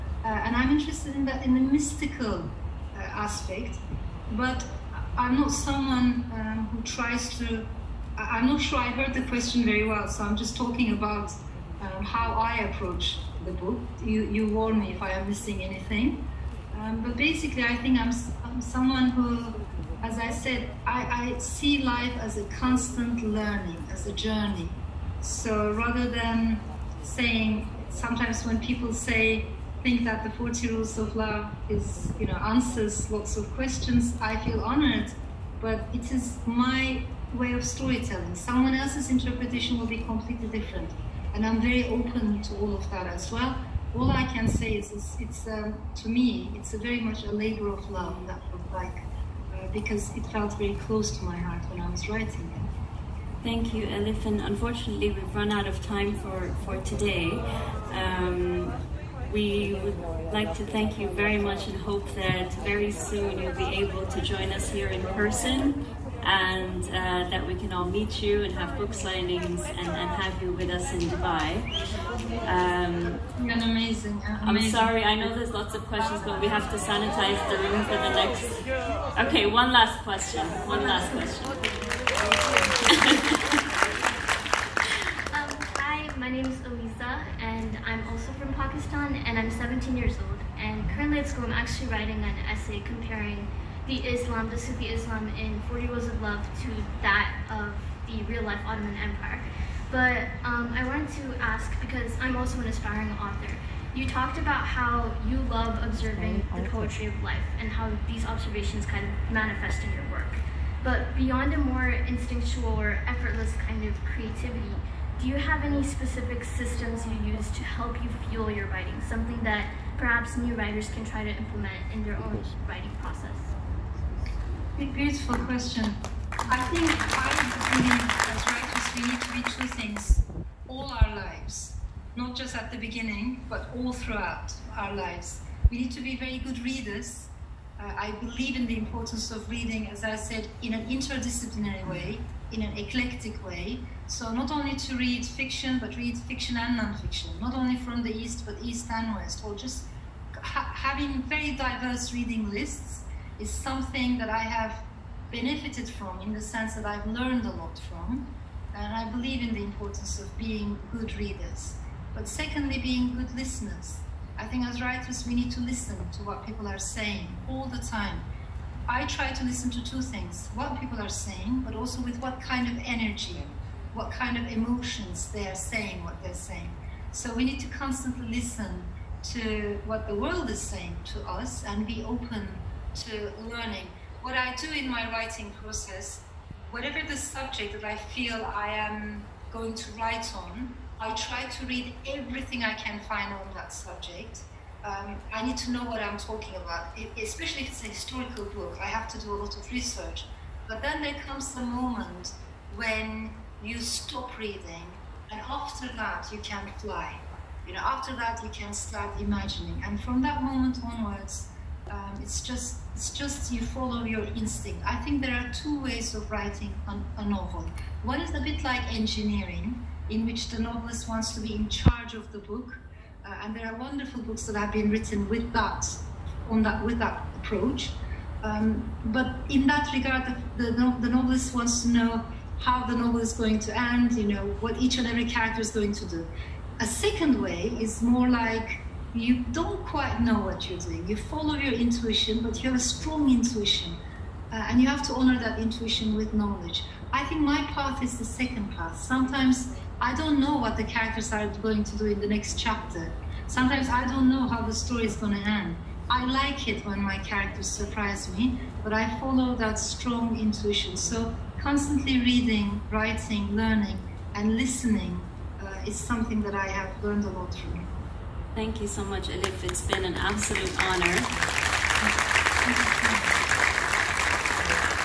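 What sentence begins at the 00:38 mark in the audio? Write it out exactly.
Someone else's interpretation will be completely different.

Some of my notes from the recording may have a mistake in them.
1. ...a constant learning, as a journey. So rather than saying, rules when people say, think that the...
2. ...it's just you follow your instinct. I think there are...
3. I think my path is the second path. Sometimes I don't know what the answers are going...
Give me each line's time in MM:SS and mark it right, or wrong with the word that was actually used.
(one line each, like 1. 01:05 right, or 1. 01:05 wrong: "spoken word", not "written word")
1. 00:22 wrong: "sometimes", not "rules"
2. 03:32 right
3. 04:07 wrong: "characters", not "answers".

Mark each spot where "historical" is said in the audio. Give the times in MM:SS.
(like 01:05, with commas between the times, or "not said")
03:17.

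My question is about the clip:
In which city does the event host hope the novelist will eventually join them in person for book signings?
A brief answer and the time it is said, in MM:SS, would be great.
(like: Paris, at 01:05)
Dubai, at 01:11.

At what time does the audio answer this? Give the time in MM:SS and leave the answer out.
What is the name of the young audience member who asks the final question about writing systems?
01:26.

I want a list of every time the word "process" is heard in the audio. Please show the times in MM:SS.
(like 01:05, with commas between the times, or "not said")
02:02, 03:05.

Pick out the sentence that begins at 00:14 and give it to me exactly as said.
You, you warn me if I am missing anything.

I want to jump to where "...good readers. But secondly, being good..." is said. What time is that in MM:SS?
02:40.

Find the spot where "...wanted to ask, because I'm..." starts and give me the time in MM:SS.
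01:40.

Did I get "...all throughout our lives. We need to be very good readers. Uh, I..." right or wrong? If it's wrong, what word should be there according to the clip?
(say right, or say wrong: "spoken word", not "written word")
right.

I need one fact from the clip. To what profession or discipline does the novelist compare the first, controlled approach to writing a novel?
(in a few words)
Engineering.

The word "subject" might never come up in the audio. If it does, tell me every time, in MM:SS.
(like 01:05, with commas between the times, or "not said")
03:07, 03:13.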